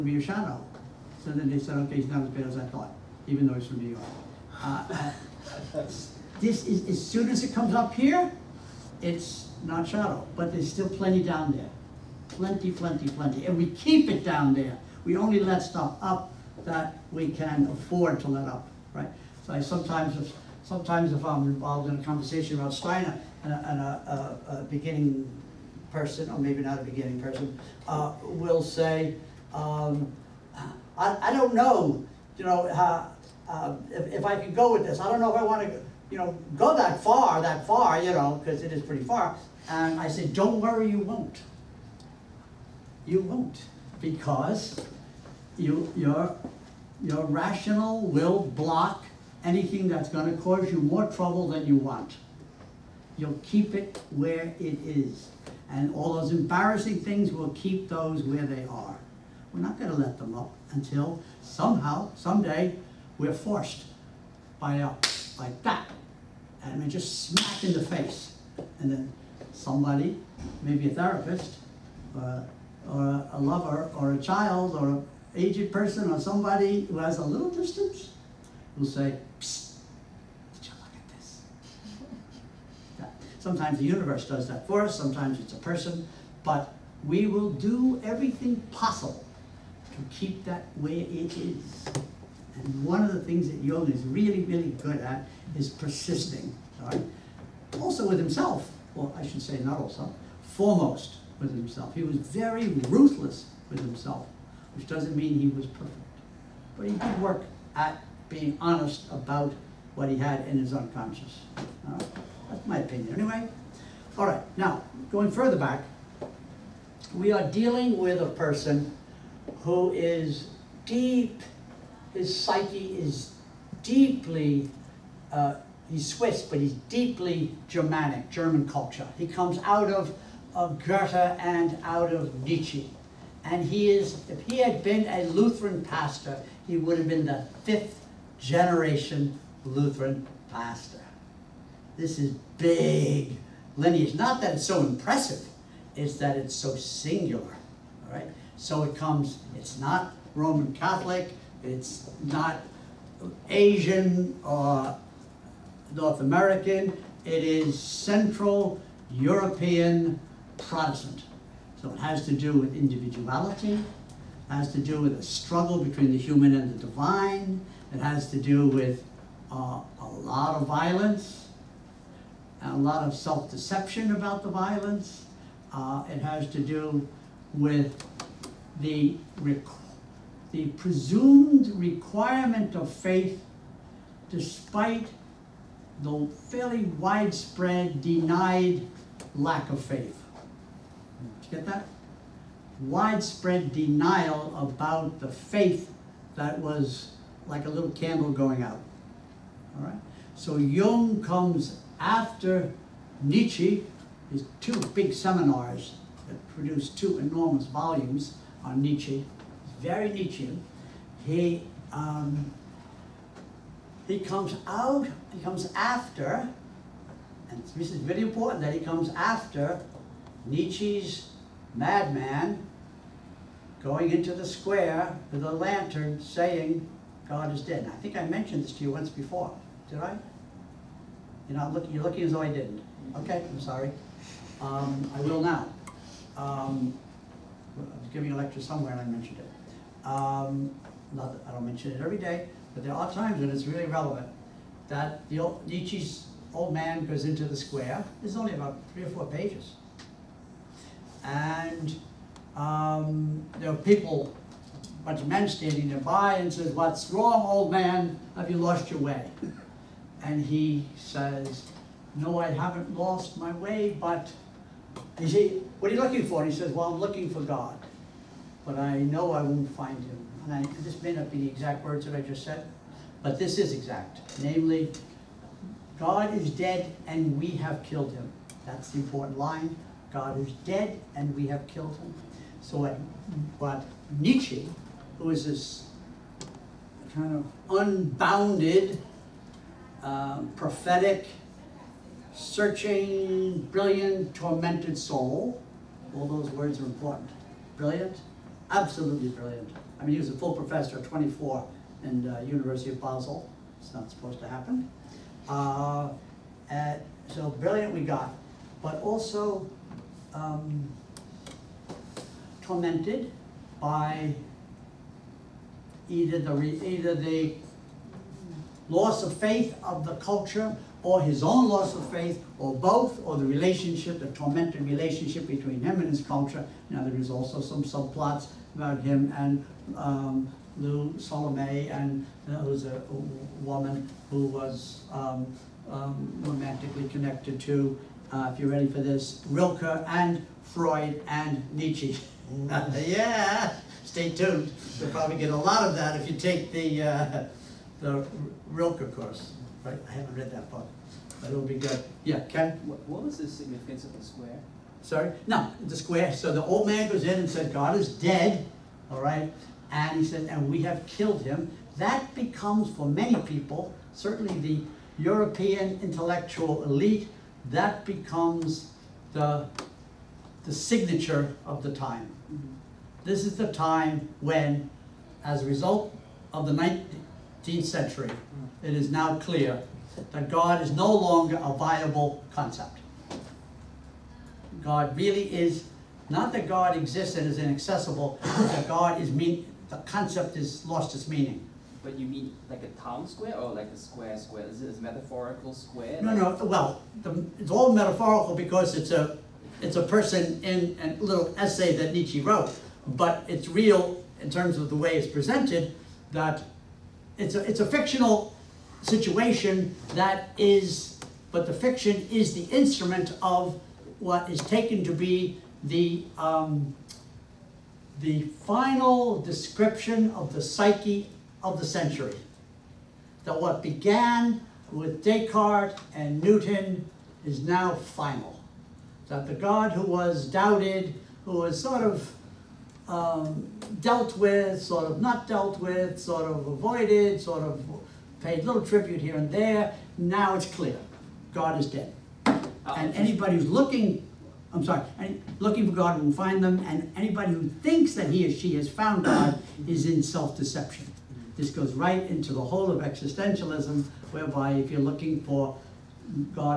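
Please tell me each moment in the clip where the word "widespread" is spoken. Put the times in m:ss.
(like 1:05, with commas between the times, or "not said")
3:06, 3:12.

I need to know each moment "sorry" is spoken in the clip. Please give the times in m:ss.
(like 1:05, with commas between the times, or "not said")
3:53, 5:55, 7:24.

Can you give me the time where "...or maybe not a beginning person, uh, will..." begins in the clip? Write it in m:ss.
0:26.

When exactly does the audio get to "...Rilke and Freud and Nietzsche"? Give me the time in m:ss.
5:39.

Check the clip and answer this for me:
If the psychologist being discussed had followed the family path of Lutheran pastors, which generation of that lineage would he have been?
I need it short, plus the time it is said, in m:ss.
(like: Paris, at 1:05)
fifth, at 2:17.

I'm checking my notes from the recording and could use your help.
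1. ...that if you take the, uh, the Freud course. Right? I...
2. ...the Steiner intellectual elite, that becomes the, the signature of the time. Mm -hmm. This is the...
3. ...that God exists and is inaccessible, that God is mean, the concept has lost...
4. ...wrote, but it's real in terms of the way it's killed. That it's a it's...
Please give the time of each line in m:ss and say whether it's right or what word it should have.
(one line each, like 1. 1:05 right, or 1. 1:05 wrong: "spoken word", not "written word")
1. 5:45 wrong: "Rilke", not "Freud"
2. 6:04 wrong: "European", not "Steiner"
3. 6:26 right
4. 6:42 wrong: "presented", not "killed".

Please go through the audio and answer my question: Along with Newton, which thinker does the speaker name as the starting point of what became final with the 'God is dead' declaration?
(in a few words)
Descartes.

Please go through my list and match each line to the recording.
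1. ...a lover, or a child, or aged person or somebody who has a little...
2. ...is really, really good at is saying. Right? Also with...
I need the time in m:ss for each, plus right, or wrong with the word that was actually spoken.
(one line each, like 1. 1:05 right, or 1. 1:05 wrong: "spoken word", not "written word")
1. 1:13 right
2. 1:33 wrong: "persisting", not "saying".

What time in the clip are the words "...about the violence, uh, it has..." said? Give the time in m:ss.
2:54.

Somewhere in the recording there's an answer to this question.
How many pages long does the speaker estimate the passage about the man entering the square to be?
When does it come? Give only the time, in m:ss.
4:08.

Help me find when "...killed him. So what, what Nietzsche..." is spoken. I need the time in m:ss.
4:41.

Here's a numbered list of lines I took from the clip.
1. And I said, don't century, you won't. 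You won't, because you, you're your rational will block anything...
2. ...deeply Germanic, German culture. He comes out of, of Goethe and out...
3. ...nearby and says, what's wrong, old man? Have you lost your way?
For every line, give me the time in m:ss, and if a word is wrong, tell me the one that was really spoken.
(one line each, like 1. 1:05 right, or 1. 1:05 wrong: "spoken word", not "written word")
1. 0:39 wrong: "worry", not "century"
2. 2:06 right
3. 4:15 right.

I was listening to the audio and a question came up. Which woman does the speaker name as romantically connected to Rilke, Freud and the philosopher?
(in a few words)
Lou Salome.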